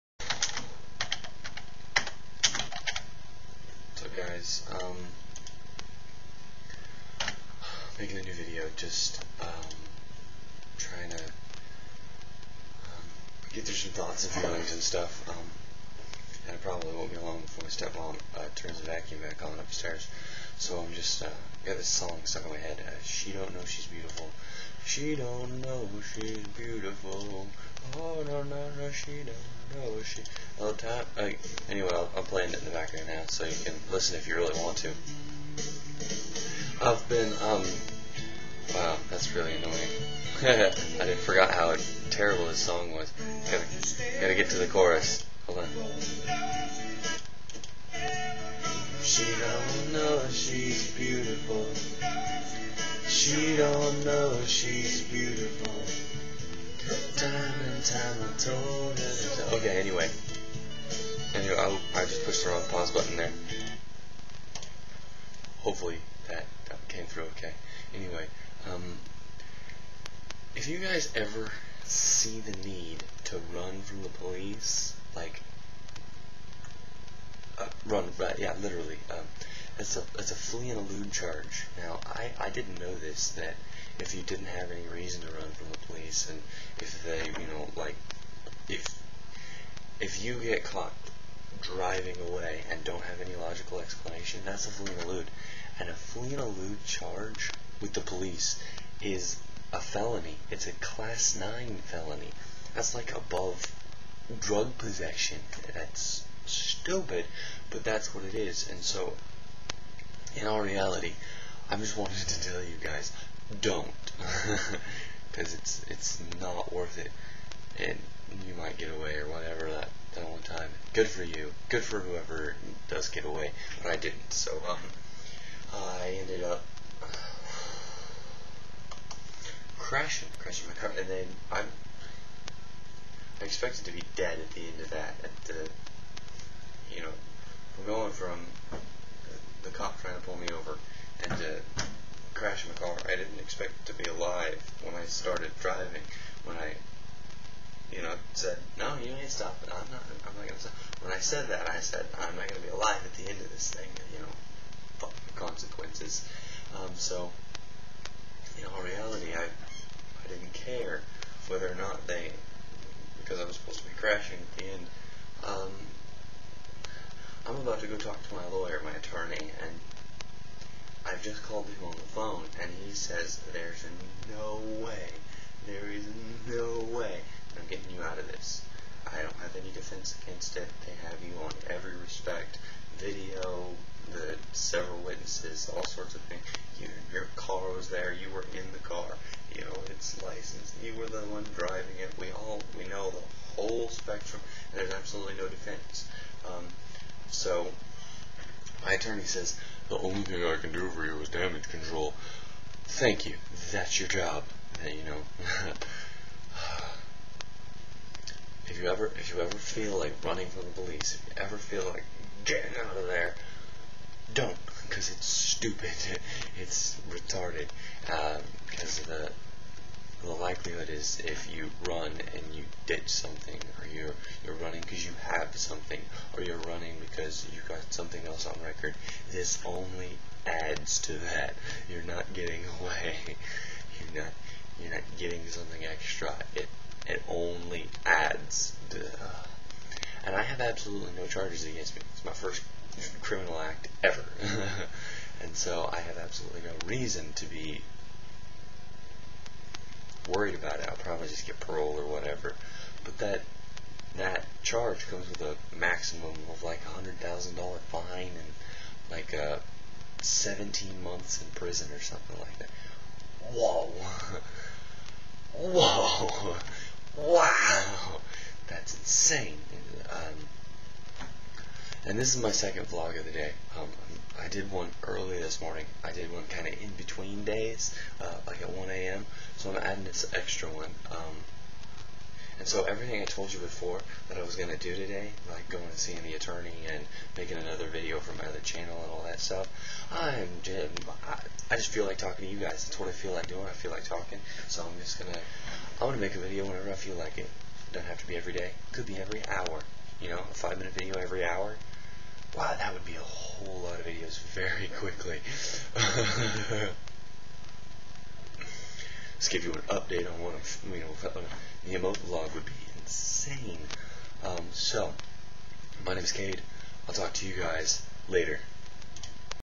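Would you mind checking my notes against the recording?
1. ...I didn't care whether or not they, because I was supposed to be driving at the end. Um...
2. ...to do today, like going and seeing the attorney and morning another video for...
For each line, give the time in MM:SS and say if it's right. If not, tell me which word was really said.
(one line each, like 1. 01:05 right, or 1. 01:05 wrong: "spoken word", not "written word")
1. 02:39 wrong: "crashing", not "driving"
2. 04:44 wrong: "making", not "morning".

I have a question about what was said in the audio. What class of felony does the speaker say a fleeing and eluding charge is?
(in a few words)
Class 9.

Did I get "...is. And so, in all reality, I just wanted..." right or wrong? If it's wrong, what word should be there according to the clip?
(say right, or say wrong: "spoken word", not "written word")
right.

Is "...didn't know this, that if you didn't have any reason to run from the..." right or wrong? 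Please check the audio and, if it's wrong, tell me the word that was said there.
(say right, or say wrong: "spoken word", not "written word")
right.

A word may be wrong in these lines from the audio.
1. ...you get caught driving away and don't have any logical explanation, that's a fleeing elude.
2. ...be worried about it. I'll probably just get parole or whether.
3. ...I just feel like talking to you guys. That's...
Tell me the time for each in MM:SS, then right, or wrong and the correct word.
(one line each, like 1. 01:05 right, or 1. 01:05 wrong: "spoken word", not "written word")
1. 01:30 right
2. 04:07 wrong: "whatever", not "whether"
3. 04:51 right.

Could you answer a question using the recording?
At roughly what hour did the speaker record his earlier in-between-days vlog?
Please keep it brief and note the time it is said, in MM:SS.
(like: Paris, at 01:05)
1 a.m., at 04:38.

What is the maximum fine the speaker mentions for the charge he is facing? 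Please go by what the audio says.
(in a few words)
$100,000.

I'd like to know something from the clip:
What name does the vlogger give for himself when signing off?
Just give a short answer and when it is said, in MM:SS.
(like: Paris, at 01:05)
Cade, at 05:16.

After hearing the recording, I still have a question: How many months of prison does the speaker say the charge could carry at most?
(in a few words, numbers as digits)
17 months.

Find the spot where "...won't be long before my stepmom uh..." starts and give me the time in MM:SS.
00:16.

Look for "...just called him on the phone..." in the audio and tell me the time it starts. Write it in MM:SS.
02:51.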